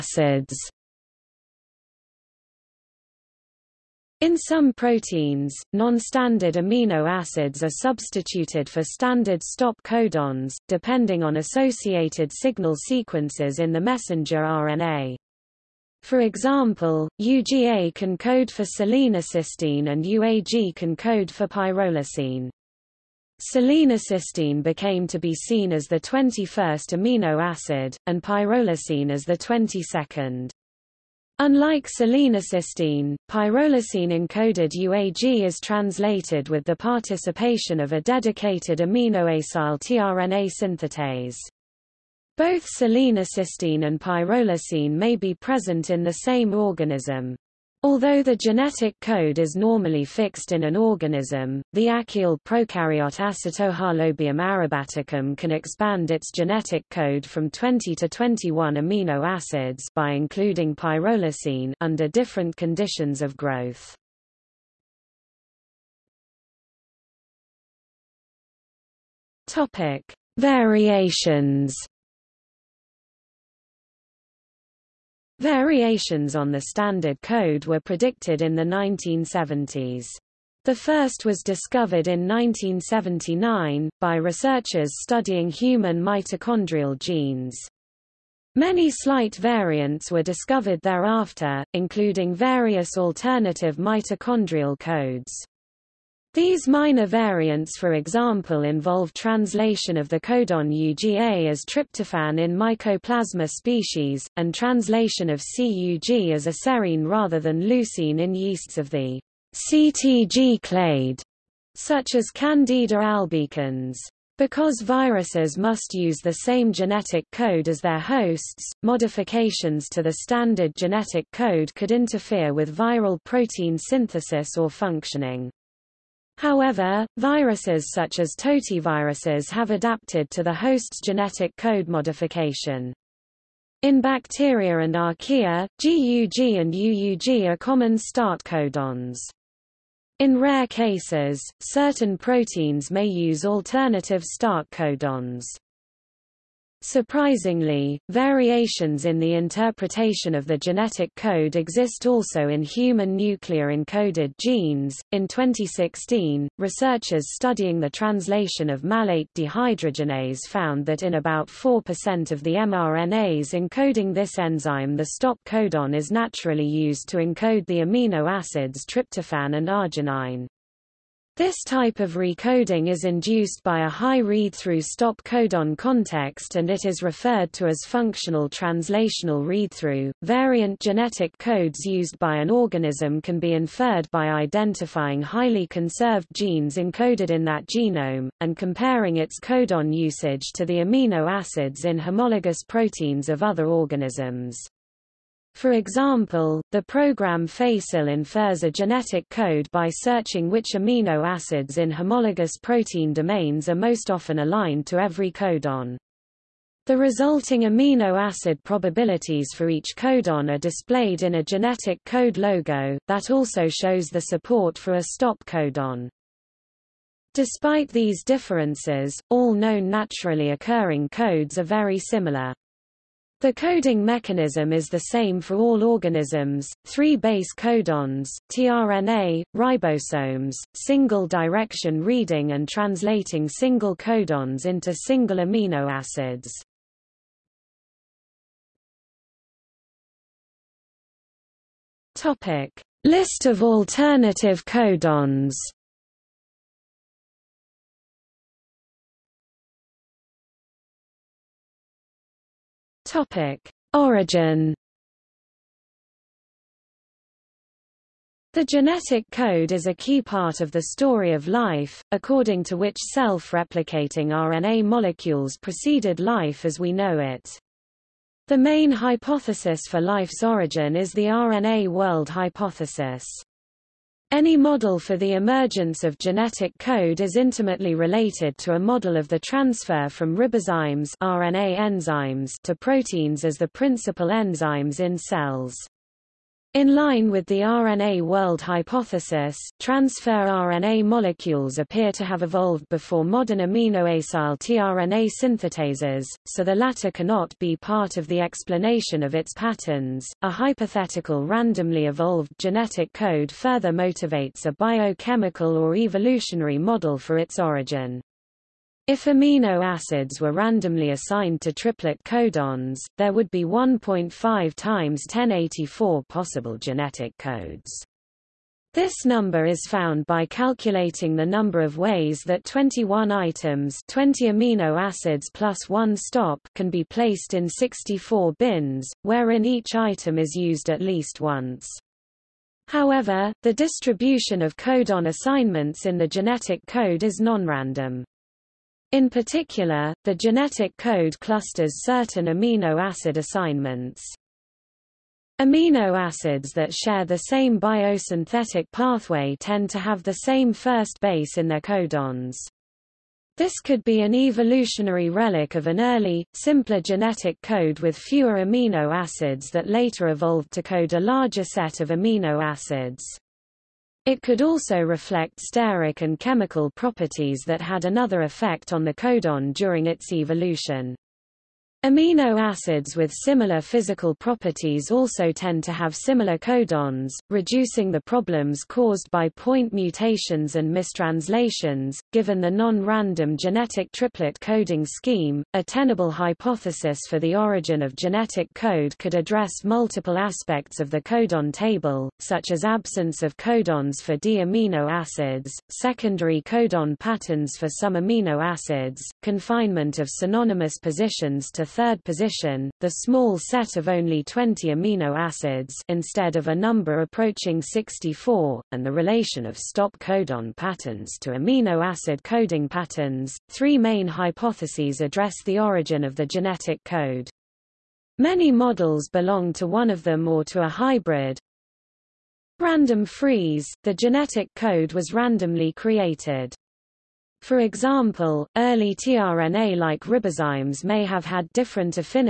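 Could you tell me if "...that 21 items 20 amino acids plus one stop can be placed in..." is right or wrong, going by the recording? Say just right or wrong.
right.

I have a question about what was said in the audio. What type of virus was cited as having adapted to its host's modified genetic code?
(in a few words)
totiviruses.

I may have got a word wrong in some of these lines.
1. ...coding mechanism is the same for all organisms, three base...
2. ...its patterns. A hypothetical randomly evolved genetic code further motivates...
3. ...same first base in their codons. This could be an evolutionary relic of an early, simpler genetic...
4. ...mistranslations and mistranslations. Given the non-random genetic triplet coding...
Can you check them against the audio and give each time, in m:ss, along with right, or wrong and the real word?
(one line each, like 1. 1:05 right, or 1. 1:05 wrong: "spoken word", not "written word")
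1. 3:43 right
2. 4:59 right
3. 5:50 right
4. 6:19 wrong: "mutations", not "mistranslations".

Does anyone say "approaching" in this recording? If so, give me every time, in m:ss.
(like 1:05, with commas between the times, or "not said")
6:47.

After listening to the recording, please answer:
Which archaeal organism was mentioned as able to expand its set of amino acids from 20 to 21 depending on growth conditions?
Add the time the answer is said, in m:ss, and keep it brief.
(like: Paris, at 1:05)
Acetohalobium arabaticum, at 0:53.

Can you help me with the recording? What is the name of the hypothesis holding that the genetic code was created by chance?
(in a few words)
Random freeze.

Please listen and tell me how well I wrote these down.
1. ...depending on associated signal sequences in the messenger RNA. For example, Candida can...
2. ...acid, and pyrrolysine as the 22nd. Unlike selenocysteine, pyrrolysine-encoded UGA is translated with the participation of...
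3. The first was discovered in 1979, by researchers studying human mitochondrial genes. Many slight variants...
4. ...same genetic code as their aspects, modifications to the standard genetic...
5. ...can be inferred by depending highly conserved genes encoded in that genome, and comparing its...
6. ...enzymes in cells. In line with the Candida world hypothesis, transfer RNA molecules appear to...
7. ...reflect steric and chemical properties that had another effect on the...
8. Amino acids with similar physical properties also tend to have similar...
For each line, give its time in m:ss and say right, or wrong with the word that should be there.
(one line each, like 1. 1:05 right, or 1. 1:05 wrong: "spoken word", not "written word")
1. 0:10 wrong: "UGA", not "Candida"
2. 0:27 wrong: "UAG", not "UGA"
3. 1:20 right
4. 1:56 wrong: "hosts", not "aspects"
5. 3:03 wrong: "identifying", not "depending"
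6. 4:44 wrong: "RNA", not "Candida"
7. 6:05 right
8. 6:12 right.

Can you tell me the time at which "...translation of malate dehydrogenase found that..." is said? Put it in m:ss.
2:37.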